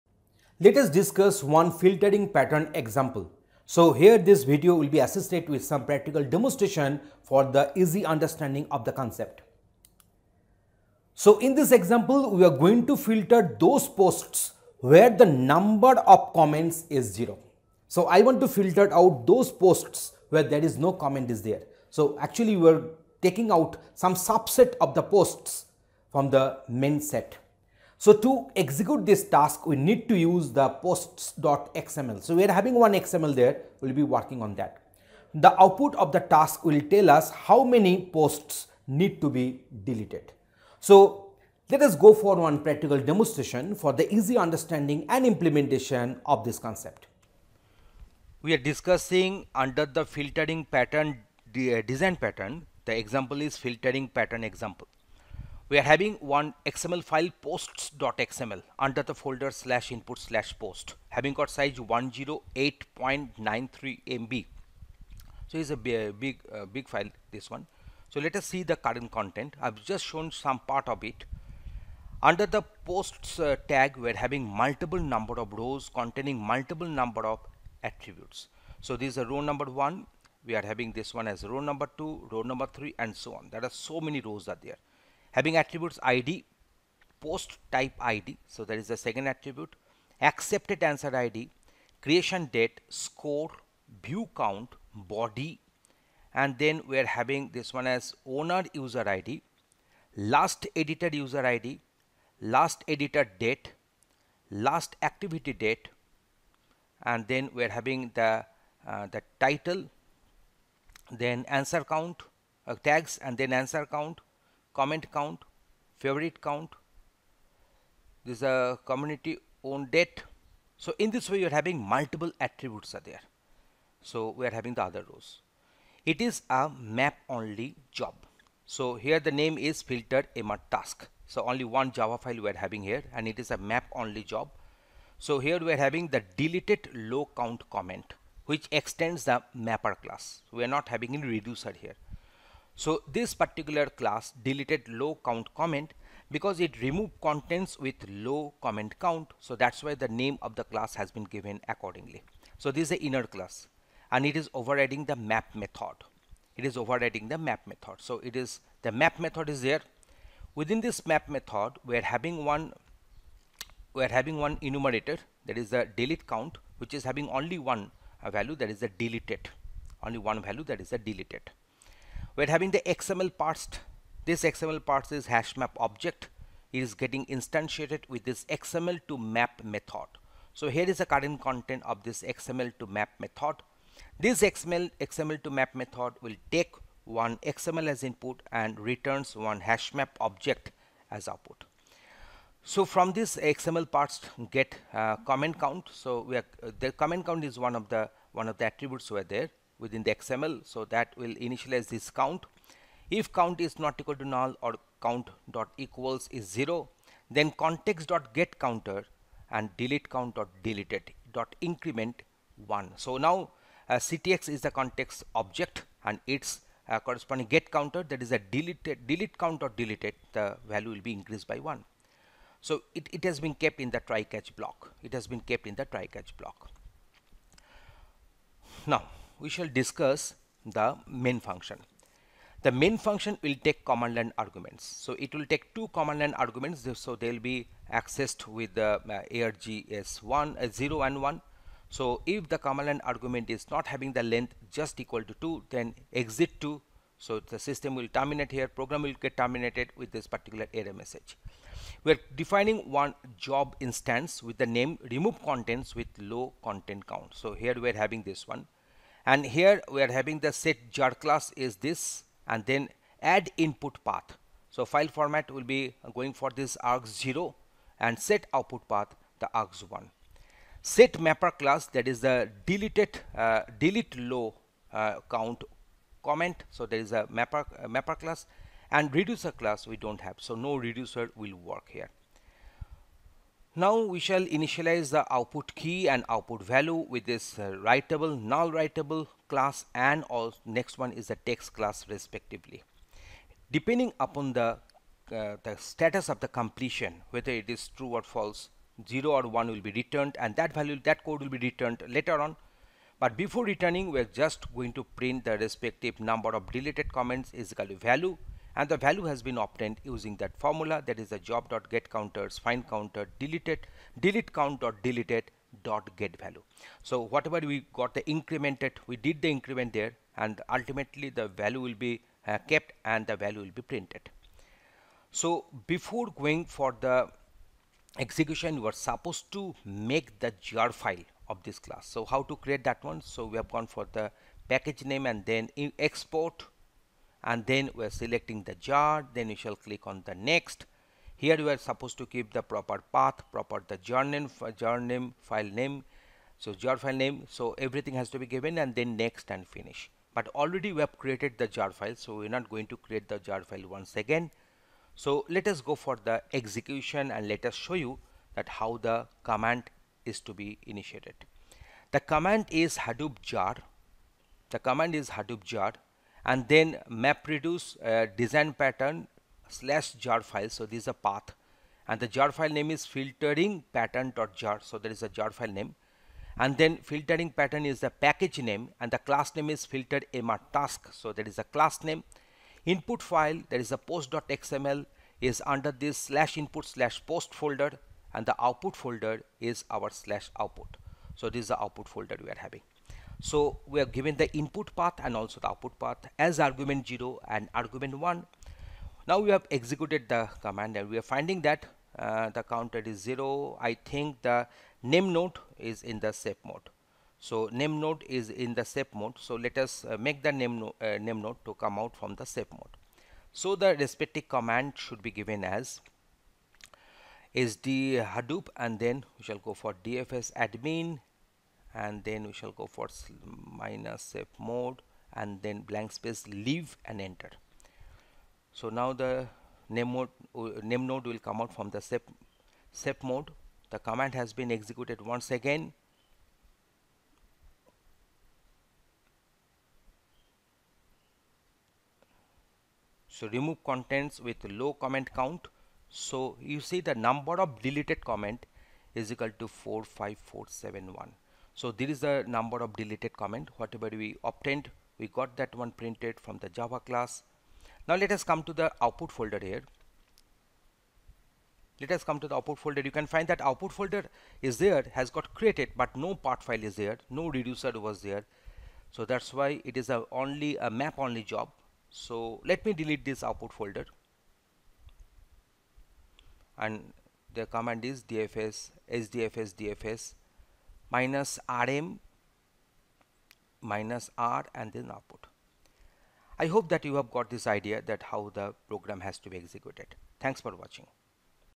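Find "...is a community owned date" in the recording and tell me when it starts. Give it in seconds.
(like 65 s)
118 s.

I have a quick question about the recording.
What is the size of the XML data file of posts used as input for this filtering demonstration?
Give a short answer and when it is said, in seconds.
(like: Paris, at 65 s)
108.93 MB, at 61 s.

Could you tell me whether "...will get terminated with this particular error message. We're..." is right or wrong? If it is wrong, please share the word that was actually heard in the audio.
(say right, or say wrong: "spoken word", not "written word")
right.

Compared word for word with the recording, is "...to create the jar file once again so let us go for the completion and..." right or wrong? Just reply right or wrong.
wrong.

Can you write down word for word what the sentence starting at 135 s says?
So here we are having the deleted low count comment which extends the mapper class.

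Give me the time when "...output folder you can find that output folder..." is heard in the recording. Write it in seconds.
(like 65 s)
462 s.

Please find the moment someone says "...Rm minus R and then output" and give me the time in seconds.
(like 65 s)
481 s.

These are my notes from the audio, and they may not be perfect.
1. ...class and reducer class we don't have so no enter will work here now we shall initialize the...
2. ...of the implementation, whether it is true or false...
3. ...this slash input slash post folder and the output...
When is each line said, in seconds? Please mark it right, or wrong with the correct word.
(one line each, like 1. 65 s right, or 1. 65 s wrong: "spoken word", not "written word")
1. 278 s wrong: "reducer", not "enter"
2. 296 s wrong: "completion", not "implementation"
3. 385 s right.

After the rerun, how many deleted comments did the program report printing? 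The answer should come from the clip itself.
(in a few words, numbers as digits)
45471.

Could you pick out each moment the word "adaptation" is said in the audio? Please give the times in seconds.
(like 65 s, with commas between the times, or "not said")
not said.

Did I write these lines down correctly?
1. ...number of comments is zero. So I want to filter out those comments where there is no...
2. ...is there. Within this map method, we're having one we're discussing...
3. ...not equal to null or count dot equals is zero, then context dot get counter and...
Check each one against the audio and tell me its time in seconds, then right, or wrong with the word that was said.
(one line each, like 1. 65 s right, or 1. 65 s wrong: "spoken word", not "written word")
1. 15 s wrong: "posts", not "comments"
2. 159 s wrong: "having", not "discussing"
3. 203 s right.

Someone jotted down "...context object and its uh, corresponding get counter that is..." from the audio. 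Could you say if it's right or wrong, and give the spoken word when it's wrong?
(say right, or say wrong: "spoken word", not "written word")
right.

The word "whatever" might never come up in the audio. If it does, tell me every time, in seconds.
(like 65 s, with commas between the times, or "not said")
317 s, 453 s.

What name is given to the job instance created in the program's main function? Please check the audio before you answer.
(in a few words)
remove contents with low content count.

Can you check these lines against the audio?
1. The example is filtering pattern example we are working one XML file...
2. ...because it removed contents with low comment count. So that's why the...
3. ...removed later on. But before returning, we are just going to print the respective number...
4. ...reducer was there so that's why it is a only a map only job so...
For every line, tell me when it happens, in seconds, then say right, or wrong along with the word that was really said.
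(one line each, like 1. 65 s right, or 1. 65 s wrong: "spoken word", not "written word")
1. 52 s wrong: "having", not "working"
2. 146 s right
3. 301 s wrong: "returned", not "removed"
4. 467 s right.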